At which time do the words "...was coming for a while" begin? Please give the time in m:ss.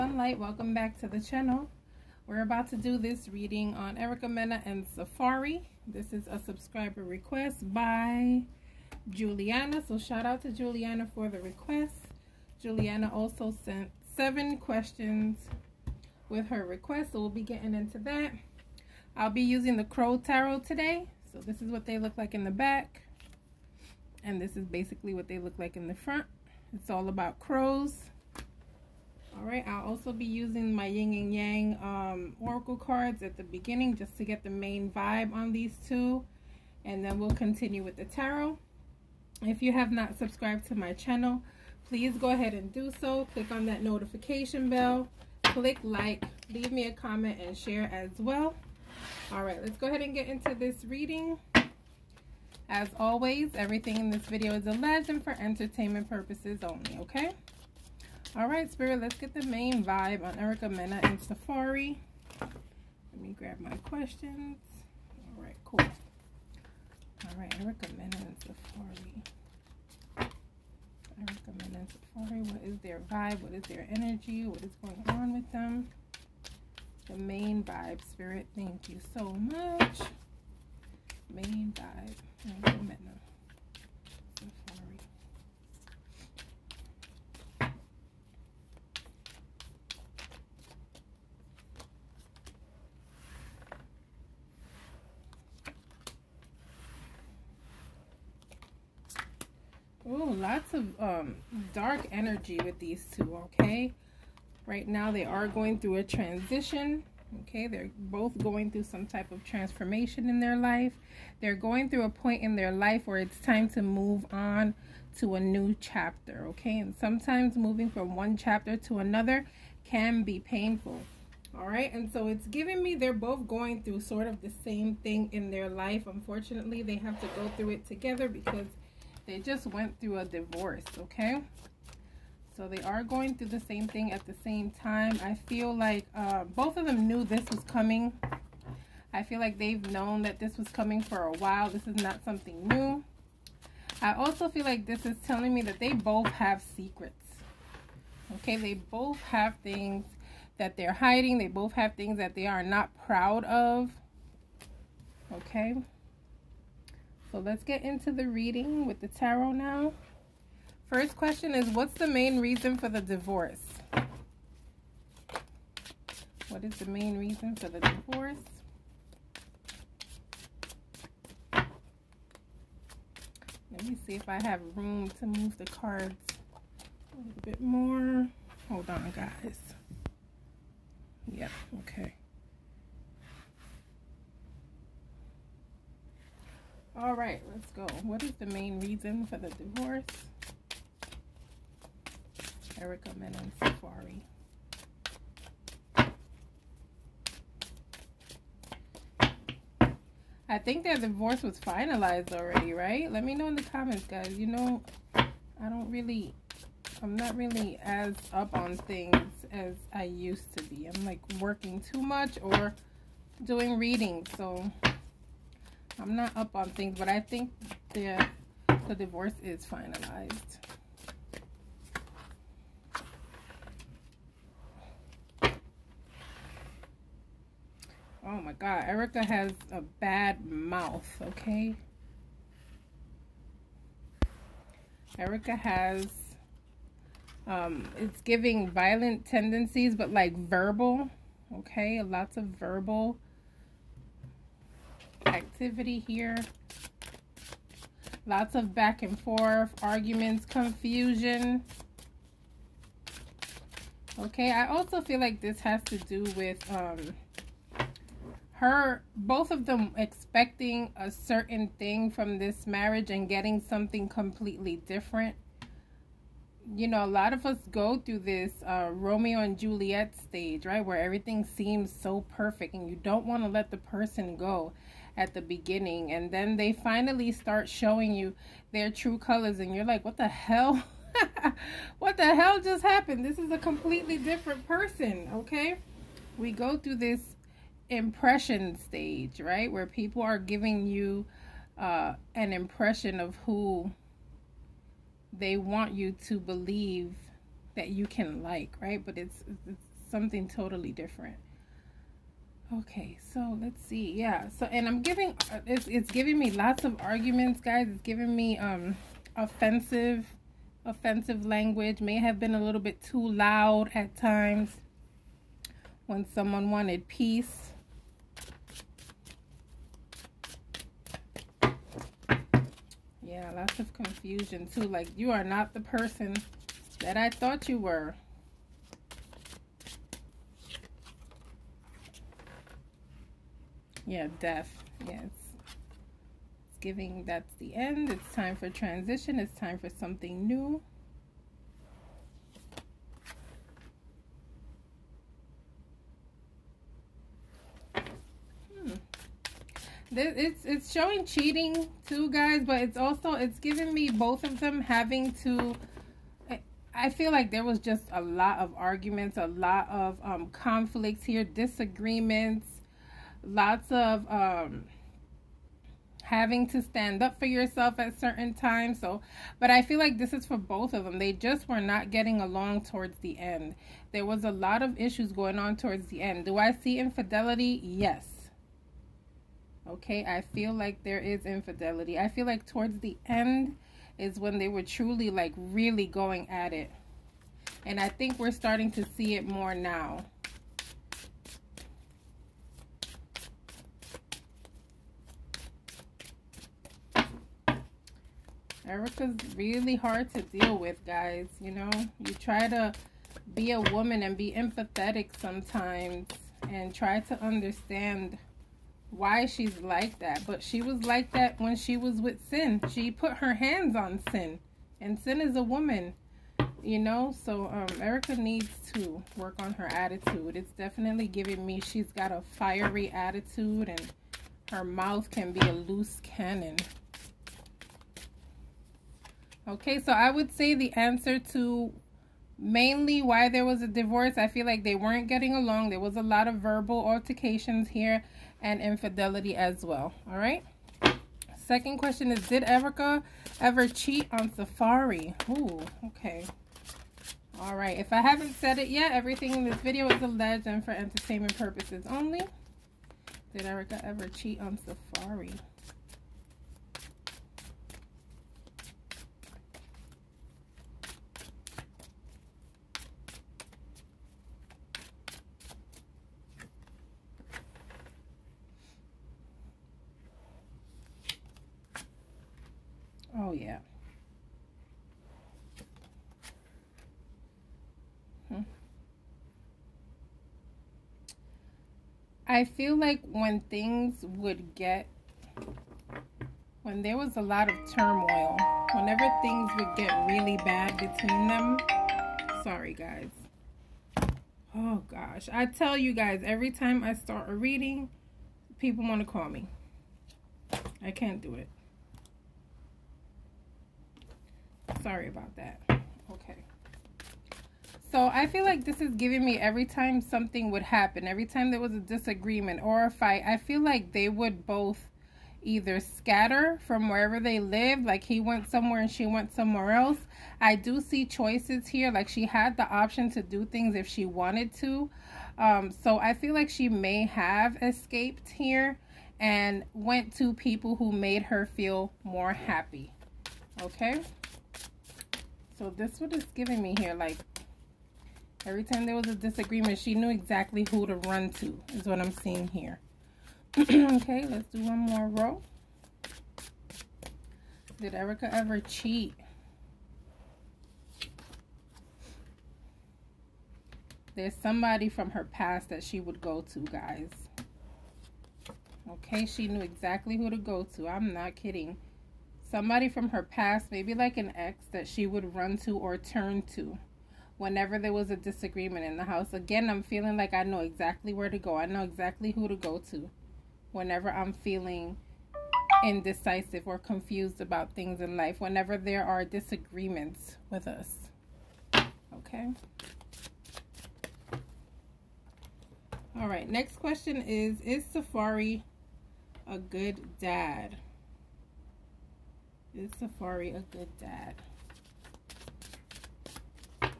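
2:20.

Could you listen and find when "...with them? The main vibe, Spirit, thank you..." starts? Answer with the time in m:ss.
1:15.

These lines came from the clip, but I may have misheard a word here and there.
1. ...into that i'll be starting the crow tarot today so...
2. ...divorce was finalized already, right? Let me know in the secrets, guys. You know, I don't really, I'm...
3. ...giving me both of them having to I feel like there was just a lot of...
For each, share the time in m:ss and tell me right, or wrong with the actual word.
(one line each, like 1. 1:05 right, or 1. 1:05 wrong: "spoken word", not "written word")
1. 0:17 wrong: "using", not "starting"
2. 3:20 wrong: "comments", not "secrets"
3. 5:53 right.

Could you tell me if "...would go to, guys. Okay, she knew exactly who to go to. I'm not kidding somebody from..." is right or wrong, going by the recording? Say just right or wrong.
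right.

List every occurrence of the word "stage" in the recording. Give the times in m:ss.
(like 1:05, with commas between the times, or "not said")
4:30, 4:48.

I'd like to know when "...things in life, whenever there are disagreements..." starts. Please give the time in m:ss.
9:37.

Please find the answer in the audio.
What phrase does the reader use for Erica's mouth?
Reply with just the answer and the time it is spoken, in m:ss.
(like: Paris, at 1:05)
A loose cannon, at 7:05.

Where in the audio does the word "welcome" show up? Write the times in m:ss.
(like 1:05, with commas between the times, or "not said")
0:00.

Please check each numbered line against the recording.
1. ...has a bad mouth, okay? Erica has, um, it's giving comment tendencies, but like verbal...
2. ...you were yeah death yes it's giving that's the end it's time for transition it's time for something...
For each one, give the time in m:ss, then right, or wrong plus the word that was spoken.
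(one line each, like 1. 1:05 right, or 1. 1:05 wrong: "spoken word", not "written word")
1. 3:49 wrong: "violent", not "comment"
2. 5:27 right.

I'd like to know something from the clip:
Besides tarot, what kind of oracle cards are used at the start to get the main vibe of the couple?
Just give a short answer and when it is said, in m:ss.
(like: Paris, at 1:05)
Yin and yang, at 0:30.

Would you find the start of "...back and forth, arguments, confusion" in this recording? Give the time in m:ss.
4:08.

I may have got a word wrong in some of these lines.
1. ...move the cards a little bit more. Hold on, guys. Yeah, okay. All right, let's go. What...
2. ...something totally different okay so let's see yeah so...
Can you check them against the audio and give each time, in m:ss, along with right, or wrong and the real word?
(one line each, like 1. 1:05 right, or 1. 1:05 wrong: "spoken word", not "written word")
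1. 2:55 right
2. 5:00 right.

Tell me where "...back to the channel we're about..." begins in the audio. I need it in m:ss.
0:00.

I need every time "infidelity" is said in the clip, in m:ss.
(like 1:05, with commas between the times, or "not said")
6:16, 6:21, 7:18.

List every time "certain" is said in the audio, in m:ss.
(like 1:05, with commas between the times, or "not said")
4:21, 6:08.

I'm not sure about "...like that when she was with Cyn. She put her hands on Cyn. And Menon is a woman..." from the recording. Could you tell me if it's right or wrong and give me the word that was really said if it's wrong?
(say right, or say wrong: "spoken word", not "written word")
wrong: "Cyn", not "Menon".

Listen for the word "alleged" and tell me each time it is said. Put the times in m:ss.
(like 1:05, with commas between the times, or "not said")
0:54, 7:30.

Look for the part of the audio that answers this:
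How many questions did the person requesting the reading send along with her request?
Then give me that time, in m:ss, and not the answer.
0:14.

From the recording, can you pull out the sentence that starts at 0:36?
And then we'll continue with the tarot.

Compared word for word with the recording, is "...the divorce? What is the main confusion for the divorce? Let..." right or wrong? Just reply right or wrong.
wrong.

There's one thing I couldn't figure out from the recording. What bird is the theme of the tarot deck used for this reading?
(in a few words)
Crows.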